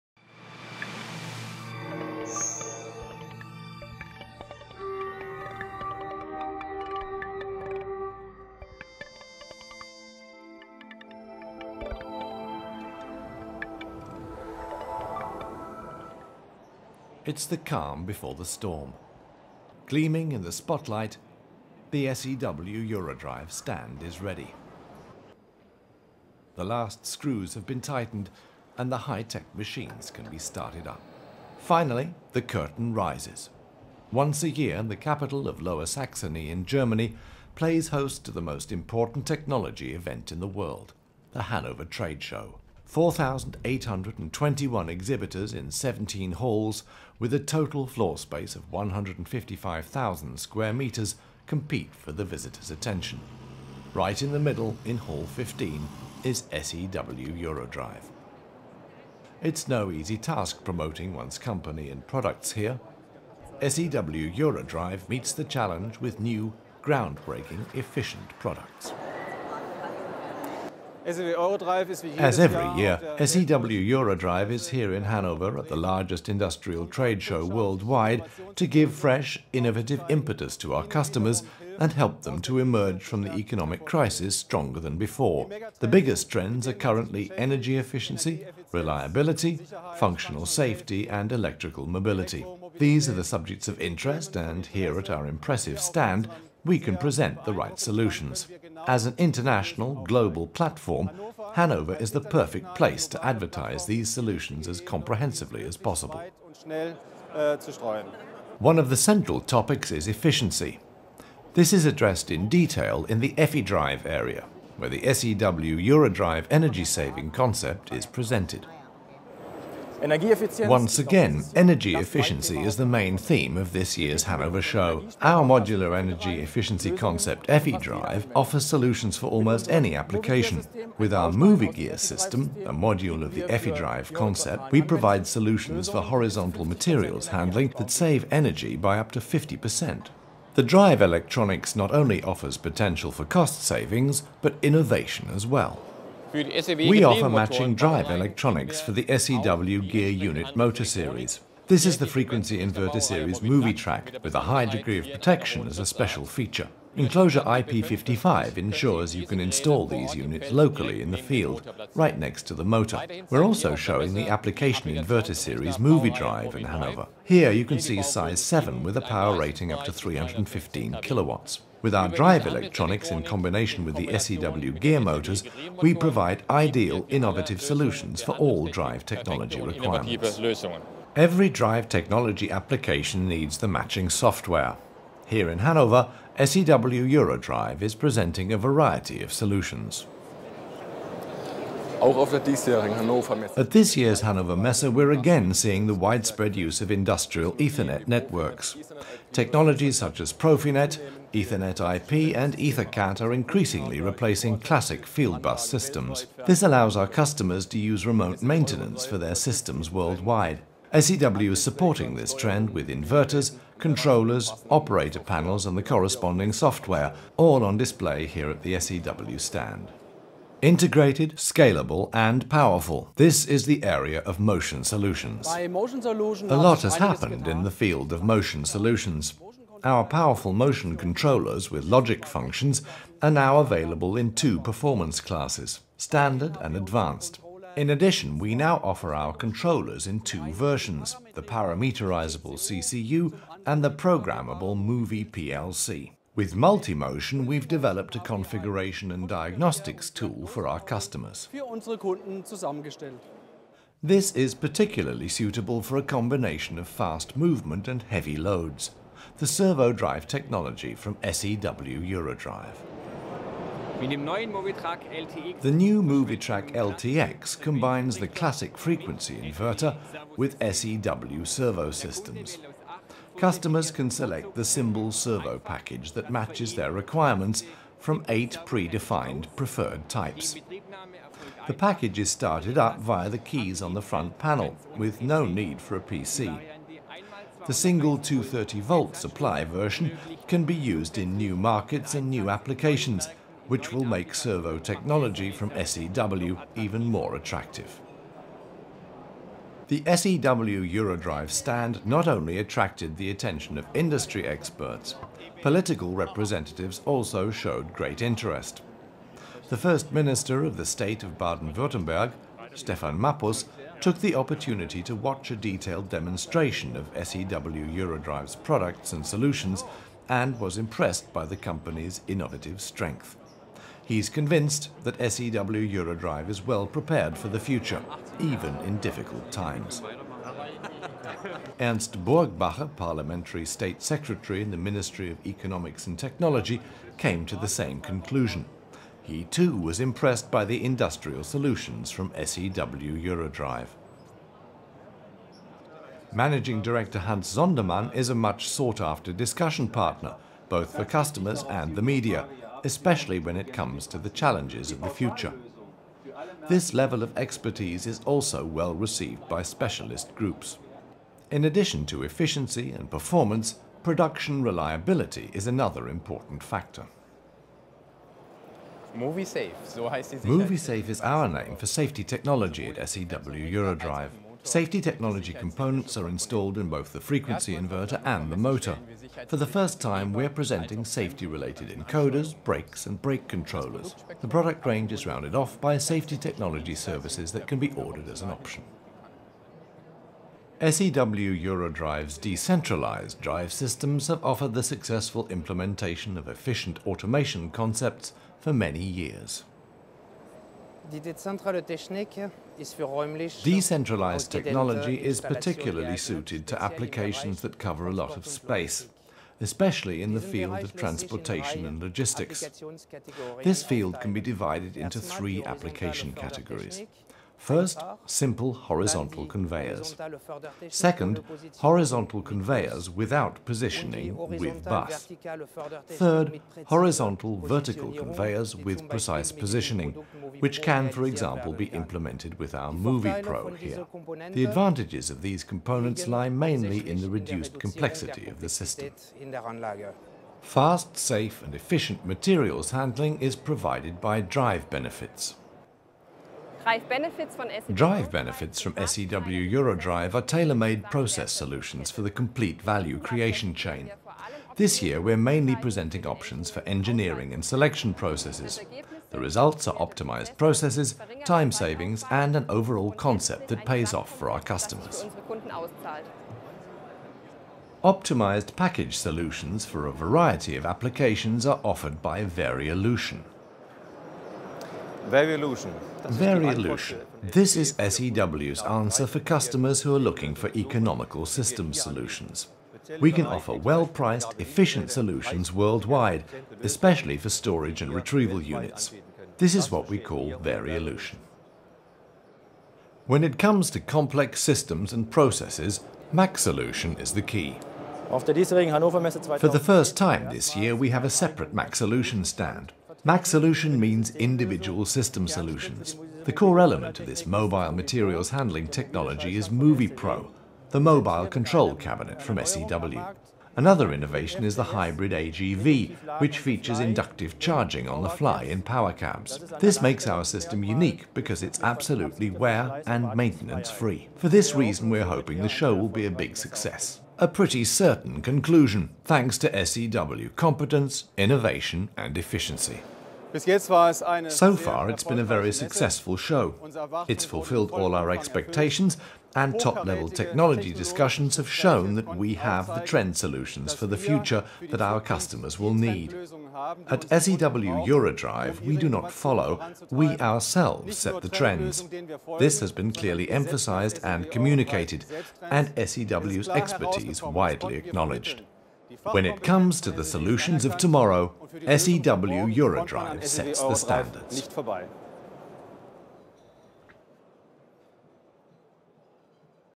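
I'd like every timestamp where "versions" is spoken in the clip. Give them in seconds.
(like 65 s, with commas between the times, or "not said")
240 s, 289 s.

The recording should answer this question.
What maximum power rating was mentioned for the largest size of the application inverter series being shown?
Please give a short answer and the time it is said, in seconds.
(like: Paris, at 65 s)
315 kilowatts, at 169 s.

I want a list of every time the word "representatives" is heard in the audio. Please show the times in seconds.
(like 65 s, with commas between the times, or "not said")
306 s.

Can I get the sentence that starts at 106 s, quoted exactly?
Äh, One of the central topics is efficiency.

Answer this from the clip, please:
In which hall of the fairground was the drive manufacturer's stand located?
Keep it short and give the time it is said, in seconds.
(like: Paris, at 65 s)
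Hall 15, at 54 s.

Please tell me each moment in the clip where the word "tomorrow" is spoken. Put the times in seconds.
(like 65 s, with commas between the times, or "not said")
560 s.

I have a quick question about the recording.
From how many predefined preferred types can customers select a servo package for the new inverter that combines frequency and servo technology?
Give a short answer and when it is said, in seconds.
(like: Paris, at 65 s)
8, at 278 s.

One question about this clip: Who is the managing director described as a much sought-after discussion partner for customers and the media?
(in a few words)
Hans Sondermann.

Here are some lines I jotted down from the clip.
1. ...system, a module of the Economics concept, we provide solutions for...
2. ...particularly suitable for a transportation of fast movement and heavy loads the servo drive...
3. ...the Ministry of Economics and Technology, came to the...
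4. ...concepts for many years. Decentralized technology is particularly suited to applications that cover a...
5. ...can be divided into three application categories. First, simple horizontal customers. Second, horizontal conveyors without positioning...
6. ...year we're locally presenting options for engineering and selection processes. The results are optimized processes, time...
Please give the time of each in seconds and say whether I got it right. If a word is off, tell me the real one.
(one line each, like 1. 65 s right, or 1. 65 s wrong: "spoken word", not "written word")
1. 131 s wrong: "EffiDrive", not "Economics"
2. 254 s wrong: "combination", not "transportation"
3. 334 s right
4. 397 s right
5. 414 s wrong: "conveyors", not "customers"
6. 455 s wrong: "mainly", not "locally".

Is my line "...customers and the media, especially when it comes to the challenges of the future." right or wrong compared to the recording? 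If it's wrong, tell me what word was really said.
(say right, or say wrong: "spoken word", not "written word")
right.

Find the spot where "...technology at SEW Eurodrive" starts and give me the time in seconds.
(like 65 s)
372 s.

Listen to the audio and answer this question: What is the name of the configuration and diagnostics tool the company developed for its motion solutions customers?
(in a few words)
Multimotion.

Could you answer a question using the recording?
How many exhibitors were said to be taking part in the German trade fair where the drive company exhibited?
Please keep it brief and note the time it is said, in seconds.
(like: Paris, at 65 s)
4,821, at 42 s.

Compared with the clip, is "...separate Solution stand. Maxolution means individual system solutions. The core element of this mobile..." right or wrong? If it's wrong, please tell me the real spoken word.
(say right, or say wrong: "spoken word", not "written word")
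right.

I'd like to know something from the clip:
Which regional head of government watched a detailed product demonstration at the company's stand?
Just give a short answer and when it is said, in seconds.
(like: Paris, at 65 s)
Stefan Mappus, at 312 s.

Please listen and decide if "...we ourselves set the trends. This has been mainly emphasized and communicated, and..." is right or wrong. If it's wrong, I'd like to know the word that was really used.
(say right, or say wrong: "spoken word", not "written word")
wrong: "clearly", not "mainly".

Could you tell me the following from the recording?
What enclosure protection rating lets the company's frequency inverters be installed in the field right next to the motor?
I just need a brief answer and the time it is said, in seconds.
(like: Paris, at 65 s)
IP55, at 157 s.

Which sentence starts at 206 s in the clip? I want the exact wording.
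This allows our customers to use remote maintenance for their systems worldwide.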